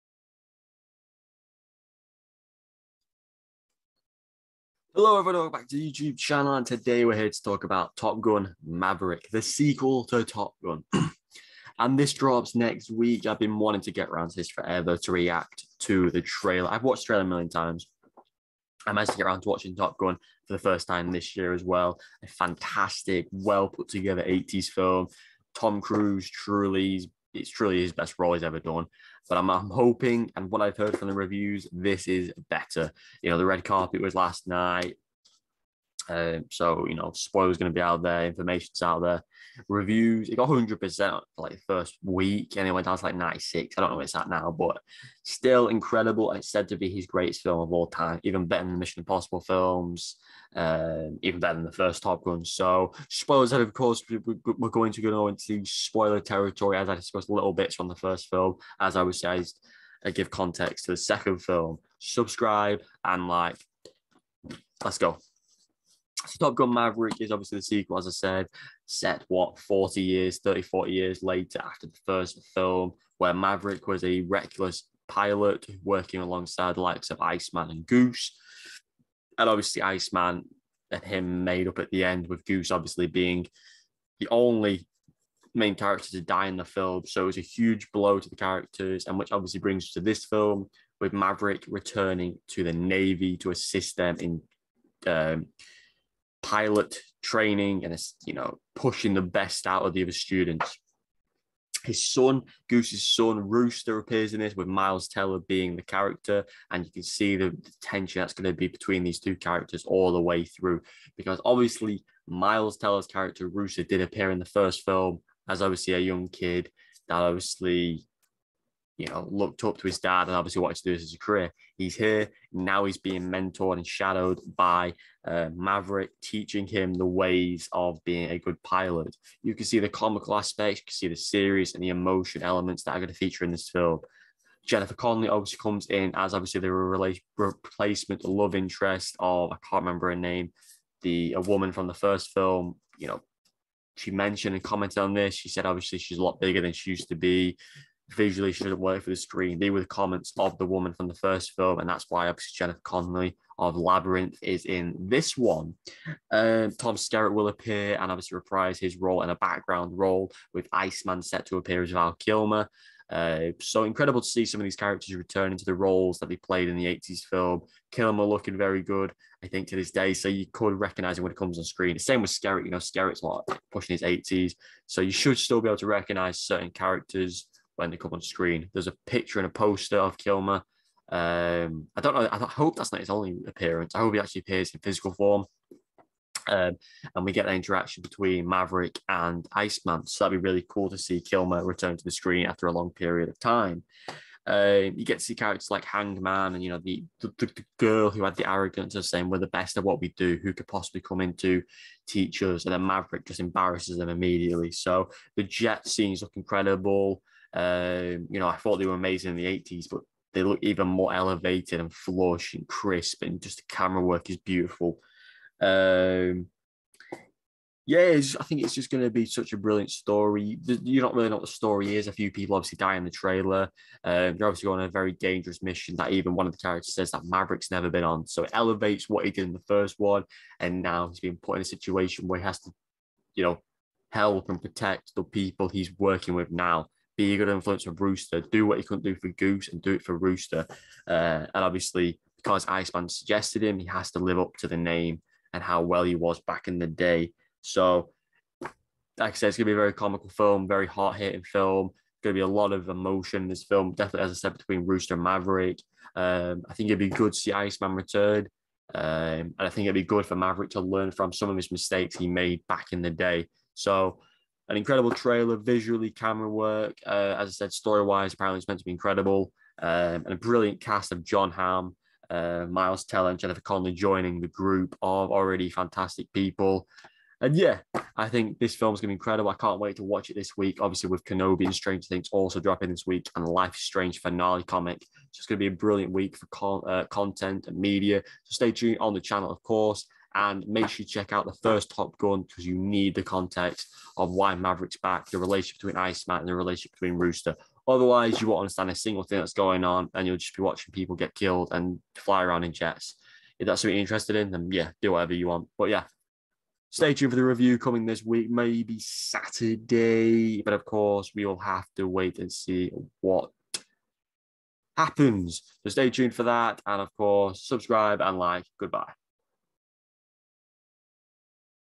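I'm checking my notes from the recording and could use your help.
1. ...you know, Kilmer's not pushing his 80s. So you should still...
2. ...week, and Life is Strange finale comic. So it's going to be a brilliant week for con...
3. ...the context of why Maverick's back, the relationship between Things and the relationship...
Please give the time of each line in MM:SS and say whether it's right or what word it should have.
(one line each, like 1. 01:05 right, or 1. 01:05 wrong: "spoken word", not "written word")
1. 02:52 wrong: "Skerritt", not "Kilmer"
2. 04:43 right
3. 04:53 wrong: "Iceman", not "Things".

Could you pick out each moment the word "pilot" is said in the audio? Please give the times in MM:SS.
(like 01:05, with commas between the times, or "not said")
01:15, 01:36, 02:08.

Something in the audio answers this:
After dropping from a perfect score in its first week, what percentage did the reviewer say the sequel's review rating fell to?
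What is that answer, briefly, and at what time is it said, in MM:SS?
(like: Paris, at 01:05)
96, at 00:43.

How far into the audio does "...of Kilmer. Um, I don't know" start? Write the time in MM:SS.
02:59.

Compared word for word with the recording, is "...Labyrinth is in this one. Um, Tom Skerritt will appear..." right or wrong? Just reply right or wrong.
right.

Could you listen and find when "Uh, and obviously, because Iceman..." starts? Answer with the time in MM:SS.
04:01.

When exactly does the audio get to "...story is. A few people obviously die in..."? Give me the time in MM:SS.
03:41.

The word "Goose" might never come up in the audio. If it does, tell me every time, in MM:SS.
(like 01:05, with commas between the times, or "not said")
01:17, 01:22, 01:42, 03:59.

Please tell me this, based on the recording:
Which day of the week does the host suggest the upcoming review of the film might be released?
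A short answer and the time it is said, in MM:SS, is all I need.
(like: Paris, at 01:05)
Saturday, at 05:08.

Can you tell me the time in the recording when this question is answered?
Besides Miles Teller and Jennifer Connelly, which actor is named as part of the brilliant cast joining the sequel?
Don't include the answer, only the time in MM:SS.
04:31.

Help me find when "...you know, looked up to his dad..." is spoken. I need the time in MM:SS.
01:58.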